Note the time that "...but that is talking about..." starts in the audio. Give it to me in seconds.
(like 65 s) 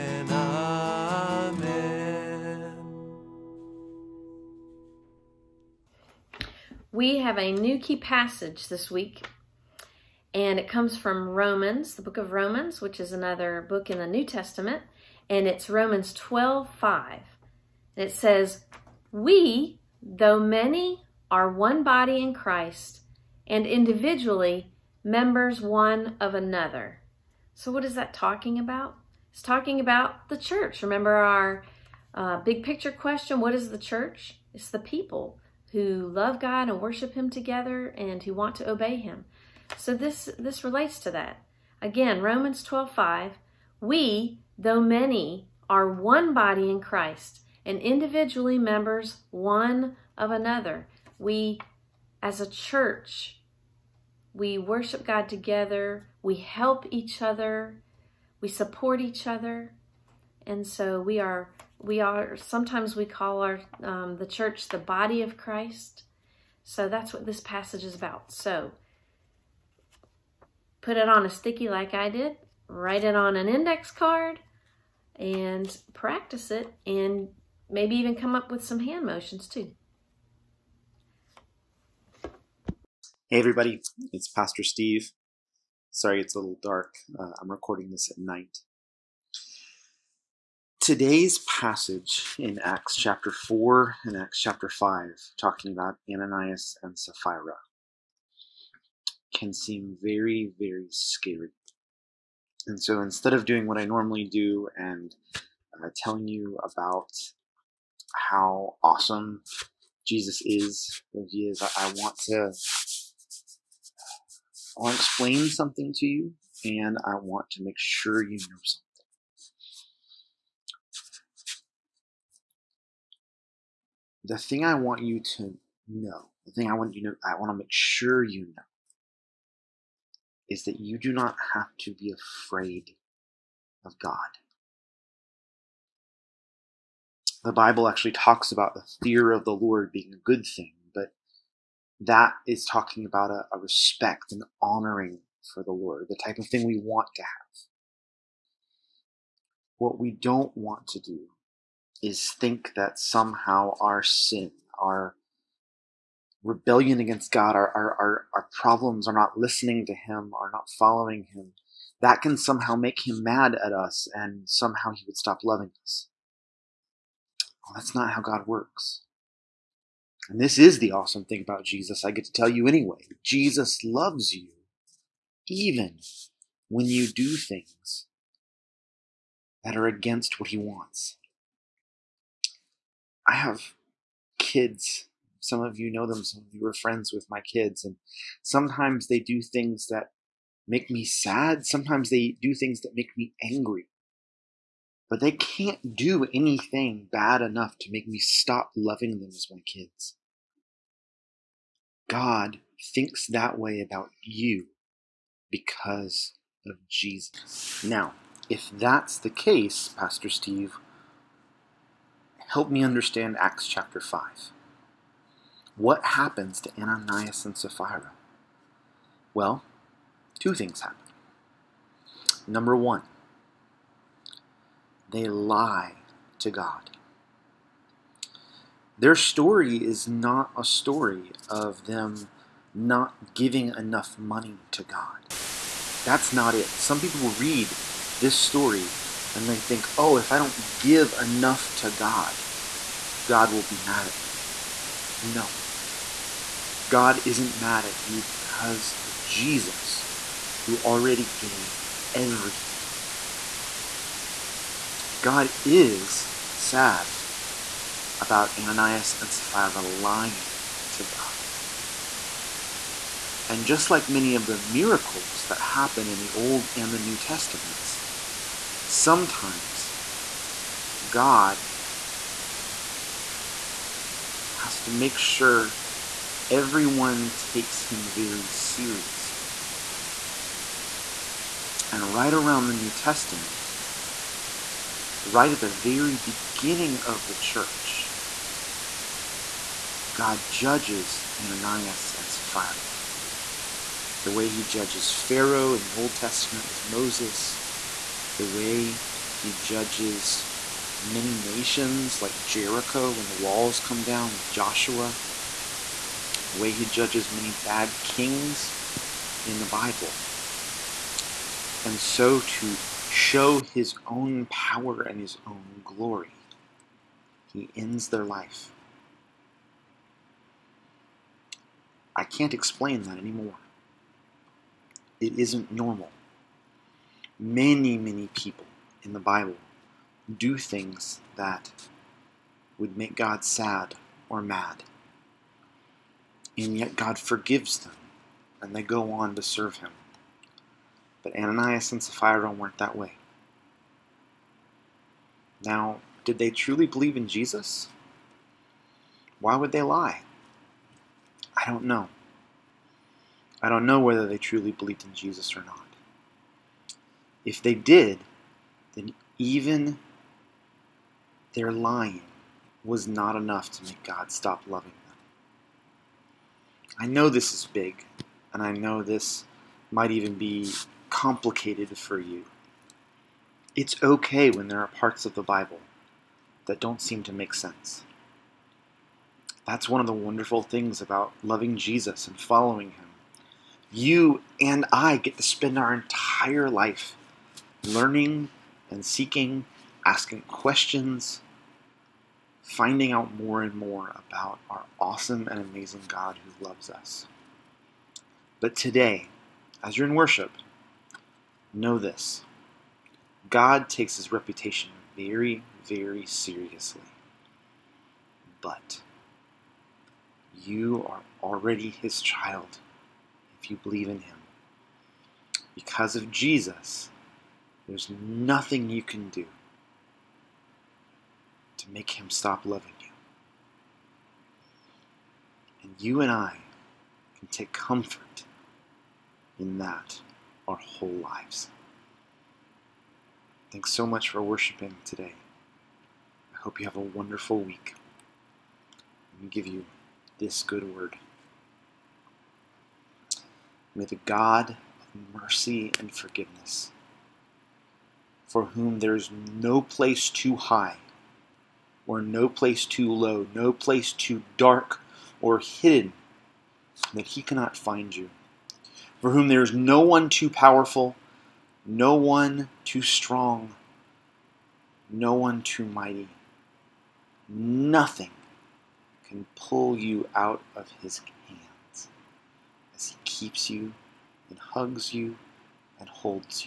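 140 s.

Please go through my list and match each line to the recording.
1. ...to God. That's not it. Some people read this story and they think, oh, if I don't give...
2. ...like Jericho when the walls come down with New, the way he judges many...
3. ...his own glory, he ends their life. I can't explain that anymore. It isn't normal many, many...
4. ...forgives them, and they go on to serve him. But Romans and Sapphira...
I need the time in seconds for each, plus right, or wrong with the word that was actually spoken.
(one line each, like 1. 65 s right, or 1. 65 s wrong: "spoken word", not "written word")
1. 234 s right
2. 302 s wrong: "Joshua", not "New"
3. 315 s right
4. 337 s wrong: "Ananias", not "Romans".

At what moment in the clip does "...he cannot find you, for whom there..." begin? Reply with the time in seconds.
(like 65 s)
457 s.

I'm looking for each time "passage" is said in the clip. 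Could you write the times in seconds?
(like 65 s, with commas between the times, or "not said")
7 s, 67 s, 91 s.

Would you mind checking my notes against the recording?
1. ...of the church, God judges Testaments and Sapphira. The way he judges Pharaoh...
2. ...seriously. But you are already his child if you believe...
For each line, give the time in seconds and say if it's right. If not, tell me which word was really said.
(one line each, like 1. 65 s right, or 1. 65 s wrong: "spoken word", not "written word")
1. 287 s wrong: "Ananias", not "Testaments"
2. 406 s right.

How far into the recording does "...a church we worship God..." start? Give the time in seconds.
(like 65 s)
52 s.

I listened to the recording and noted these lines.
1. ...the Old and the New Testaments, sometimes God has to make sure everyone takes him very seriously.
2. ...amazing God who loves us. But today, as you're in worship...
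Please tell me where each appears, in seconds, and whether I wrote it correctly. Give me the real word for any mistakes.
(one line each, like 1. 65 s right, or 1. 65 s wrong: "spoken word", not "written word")
1. 266 s right
2. 395 s right.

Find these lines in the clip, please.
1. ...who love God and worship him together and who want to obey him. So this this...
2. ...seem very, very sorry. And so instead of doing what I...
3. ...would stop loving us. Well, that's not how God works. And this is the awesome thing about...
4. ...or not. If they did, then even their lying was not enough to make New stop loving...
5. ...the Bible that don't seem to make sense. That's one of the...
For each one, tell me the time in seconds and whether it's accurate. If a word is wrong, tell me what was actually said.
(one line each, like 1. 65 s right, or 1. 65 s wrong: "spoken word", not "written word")
1. 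35 s right
2. 99 s wrong: "scary", not "sorry"
3. 165 s right
4. 355 s wrong: "God", not "New"
5. 375 s right.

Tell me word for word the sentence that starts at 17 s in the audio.
And it says, We, though many, are one body in Christ, and individually members one of another.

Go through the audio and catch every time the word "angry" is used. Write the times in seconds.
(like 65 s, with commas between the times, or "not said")
193 s.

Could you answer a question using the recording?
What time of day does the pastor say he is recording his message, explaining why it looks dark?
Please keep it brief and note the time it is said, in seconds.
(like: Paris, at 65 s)
at night, at 88 s.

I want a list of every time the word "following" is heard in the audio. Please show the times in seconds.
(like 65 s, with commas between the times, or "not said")
160 s, 382 s.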